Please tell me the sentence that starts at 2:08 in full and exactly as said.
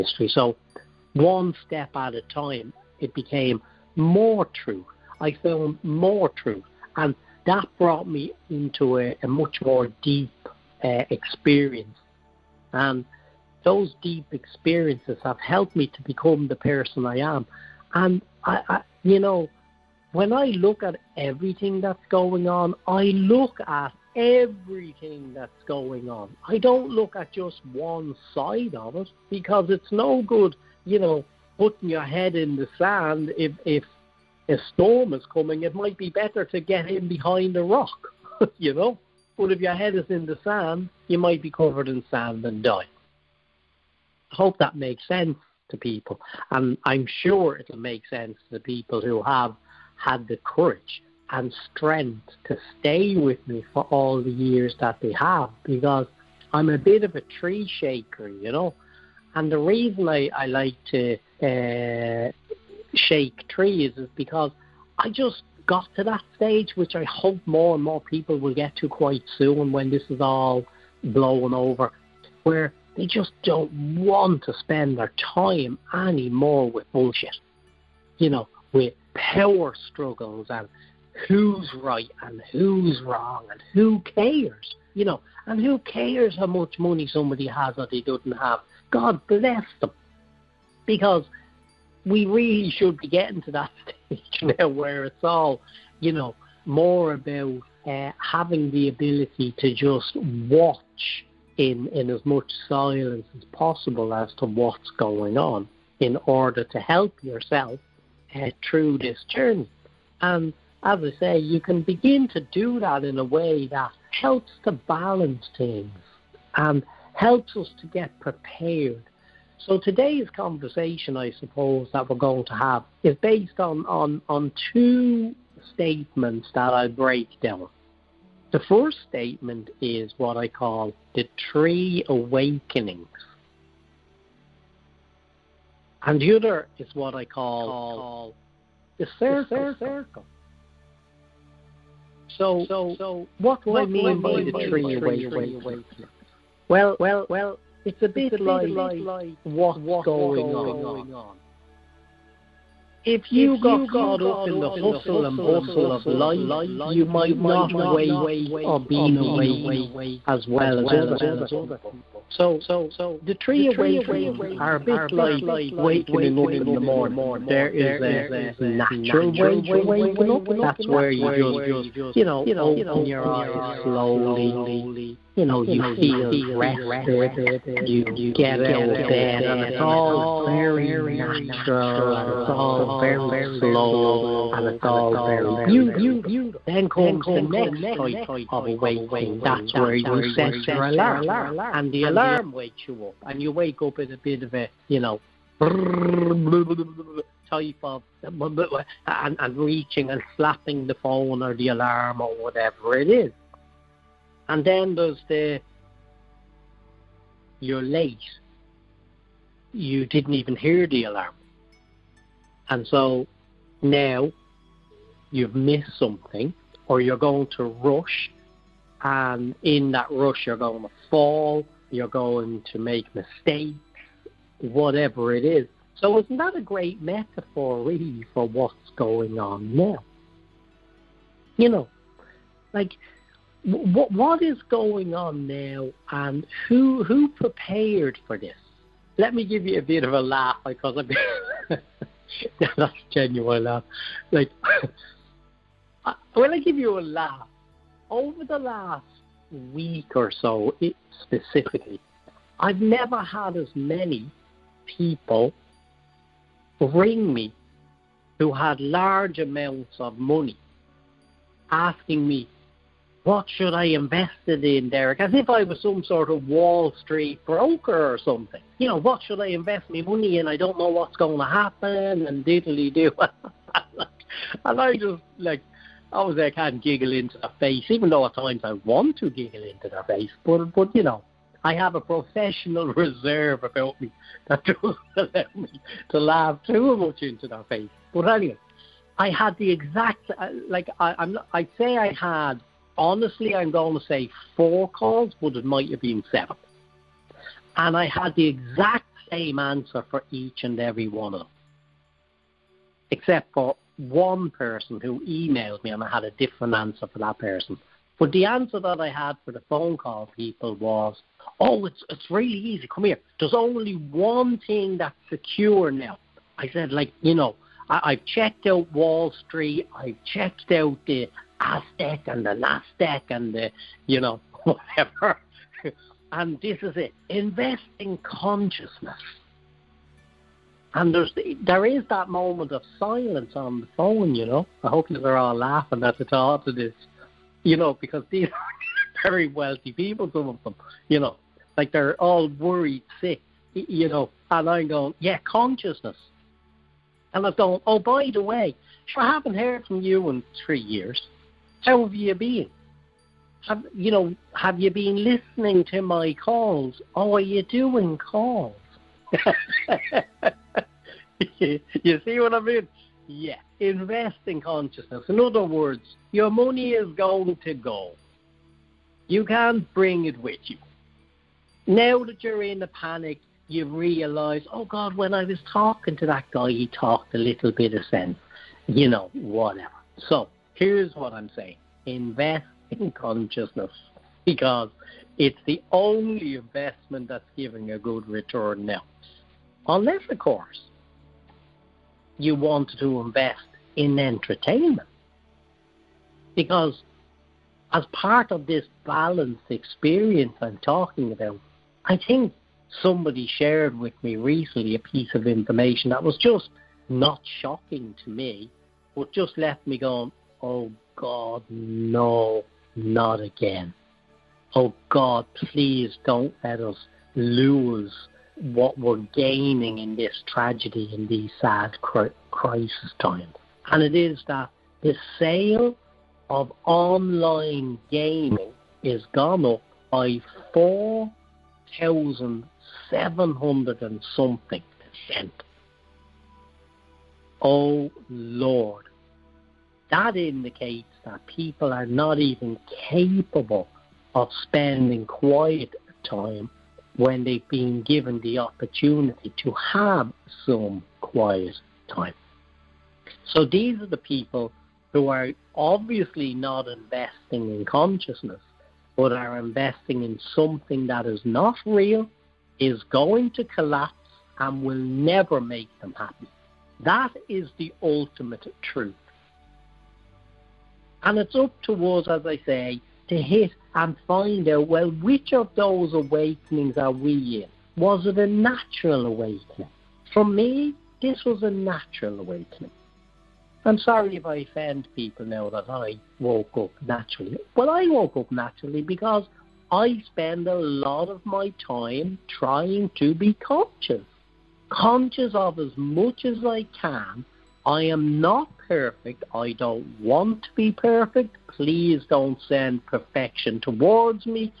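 The first statement is what I call the three awakenings.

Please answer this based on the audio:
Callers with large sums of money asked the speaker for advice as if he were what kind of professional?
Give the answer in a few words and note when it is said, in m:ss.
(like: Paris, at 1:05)
Wall Street broker, at 4:26.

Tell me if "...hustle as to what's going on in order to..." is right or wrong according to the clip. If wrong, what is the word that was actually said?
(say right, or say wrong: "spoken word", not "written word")
wrong: "possible", not "hustle".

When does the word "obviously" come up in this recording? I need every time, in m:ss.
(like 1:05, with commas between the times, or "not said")
4:36, 7:35.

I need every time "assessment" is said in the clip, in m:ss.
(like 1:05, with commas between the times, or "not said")
not said.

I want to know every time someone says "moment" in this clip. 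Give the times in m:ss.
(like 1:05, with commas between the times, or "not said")
5:32.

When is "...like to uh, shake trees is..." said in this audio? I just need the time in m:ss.
1:00.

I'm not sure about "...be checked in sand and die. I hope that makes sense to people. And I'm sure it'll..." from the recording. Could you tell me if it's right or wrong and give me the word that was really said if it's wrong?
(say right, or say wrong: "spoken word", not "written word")
wrong: "covered", not "checked".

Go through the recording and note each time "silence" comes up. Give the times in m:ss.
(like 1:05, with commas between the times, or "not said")
1:42, 5:33.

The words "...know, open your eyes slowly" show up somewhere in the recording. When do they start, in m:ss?
2:52.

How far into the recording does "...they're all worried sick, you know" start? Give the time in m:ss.
5:41.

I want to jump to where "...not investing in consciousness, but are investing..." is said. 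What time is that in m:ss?
7:36.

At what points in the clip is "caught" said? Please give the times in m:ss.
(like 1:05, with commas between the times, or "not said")
2:33.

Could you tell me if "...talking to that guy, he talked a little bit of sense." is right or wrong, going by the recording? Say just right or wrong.
right.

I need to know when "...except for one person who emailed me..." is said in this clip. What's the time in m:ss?
5:03.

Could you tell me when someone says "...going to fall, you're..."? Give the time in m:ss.
3:40.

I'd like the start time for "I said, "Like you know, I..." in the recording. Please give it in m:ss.
5:16.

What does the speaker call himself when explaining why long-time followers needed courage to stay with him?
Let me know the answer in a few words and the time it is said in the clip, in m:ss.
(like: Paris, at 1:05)
Tree shaker, at 0:57.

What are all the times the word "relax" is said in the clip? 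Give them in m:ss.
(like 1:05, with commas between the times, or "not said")
not said.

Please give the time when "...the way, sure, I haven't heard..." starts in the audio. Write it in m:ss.
5:48.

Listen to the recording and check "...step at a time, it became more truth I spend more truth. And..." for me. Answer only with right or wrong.
wrong.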